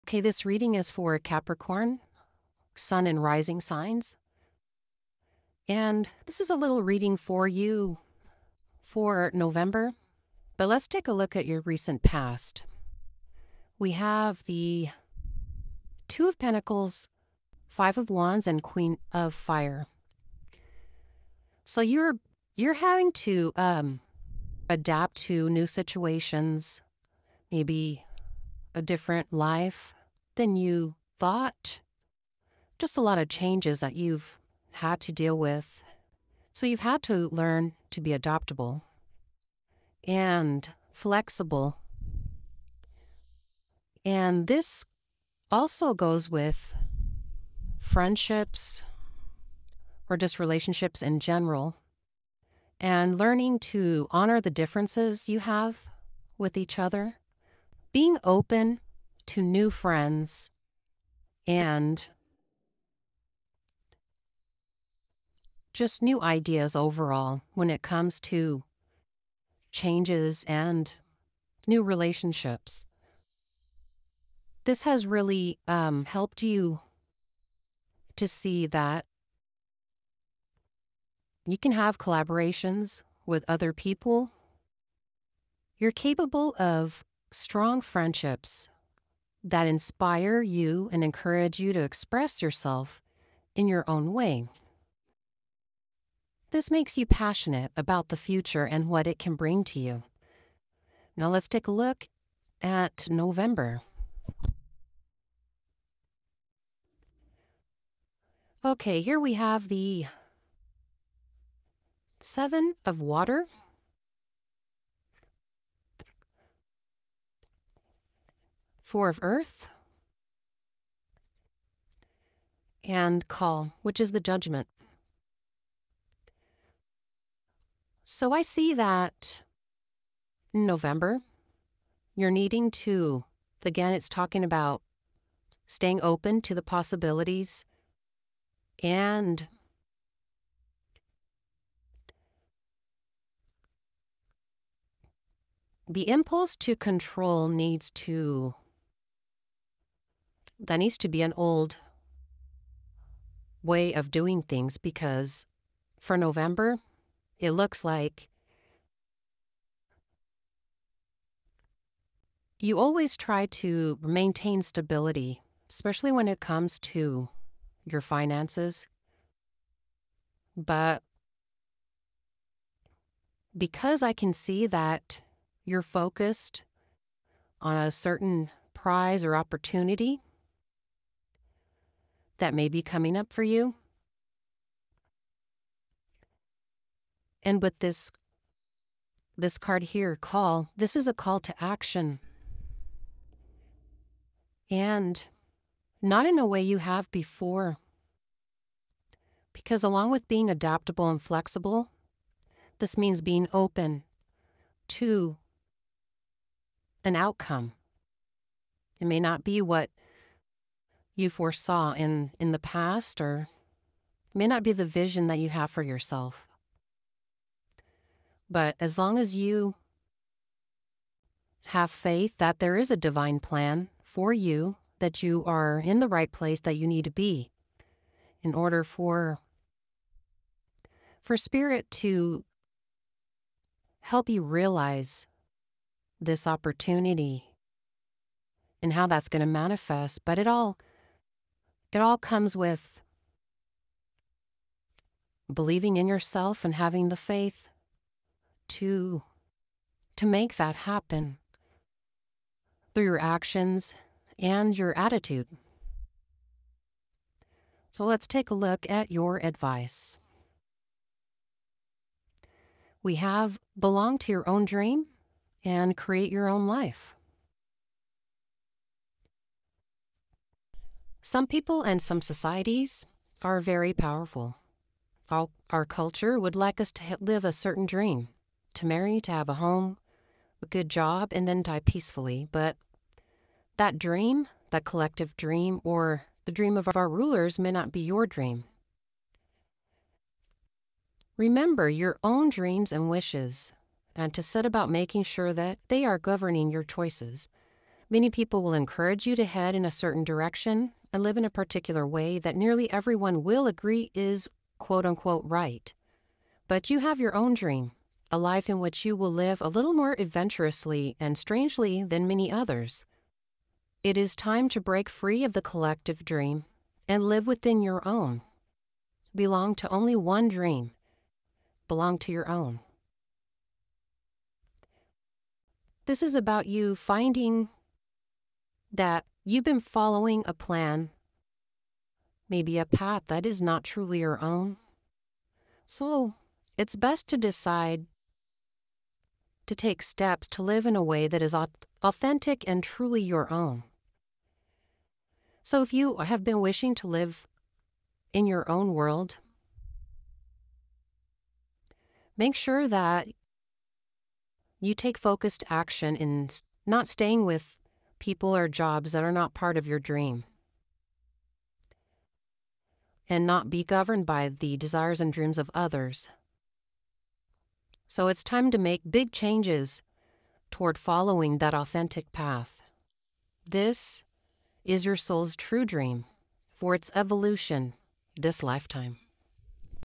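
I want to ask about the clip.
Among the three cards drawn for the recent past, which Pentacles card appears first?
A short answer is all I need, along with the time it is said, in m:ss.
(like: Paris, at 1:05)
Two of Pentacles, at 0:16.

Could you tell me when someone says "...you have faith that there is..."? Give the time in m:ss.
3:39.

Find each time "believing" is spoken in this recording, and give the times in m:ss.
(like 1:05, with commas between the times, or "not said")
4:05.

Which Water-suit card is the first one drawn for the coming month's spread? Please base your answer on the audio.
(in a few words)
Seven of Water.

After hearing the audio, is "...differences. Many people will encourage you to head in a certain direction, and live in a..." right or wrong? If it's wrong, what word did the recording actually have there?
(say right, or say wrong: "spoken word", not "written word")
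wrong: "choices", not "differences".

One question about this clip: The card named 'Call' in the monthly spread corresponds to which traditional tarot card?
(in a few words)
Judgment.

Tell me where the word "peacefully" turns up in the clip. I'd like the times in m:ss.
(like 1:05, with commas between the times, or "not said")
4:41.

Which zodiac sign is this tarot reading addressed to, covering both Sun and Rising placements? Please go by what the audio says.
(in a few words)
Capricorn.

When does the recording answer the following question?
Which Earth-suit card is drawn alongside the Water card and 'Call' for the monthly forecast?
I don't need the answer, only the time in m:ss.
1:58.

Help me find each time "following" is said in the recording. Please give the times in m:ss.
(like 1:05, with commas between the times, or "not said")
5:29, 6:10.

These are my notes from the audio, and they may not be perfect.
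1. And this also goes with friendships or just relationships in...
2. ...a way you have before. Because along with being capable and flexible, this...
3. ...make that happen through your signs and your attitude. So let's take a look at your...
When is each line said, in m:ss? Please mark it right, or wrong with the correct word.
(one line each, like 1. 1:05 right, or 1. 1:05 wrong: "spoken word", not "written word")
1. 0:44 right
2. 3:16 wrong: "adaptable", not "capable"
3. 4:10 wrong: "actions", not "signs".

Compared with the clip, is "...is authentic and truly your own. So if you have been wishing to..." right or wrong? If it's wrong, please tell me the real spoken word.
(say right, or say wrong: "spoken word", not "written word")
right.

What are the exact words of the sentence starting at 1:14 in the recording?
This has really um, helped you to see that you can have collaborations with other people.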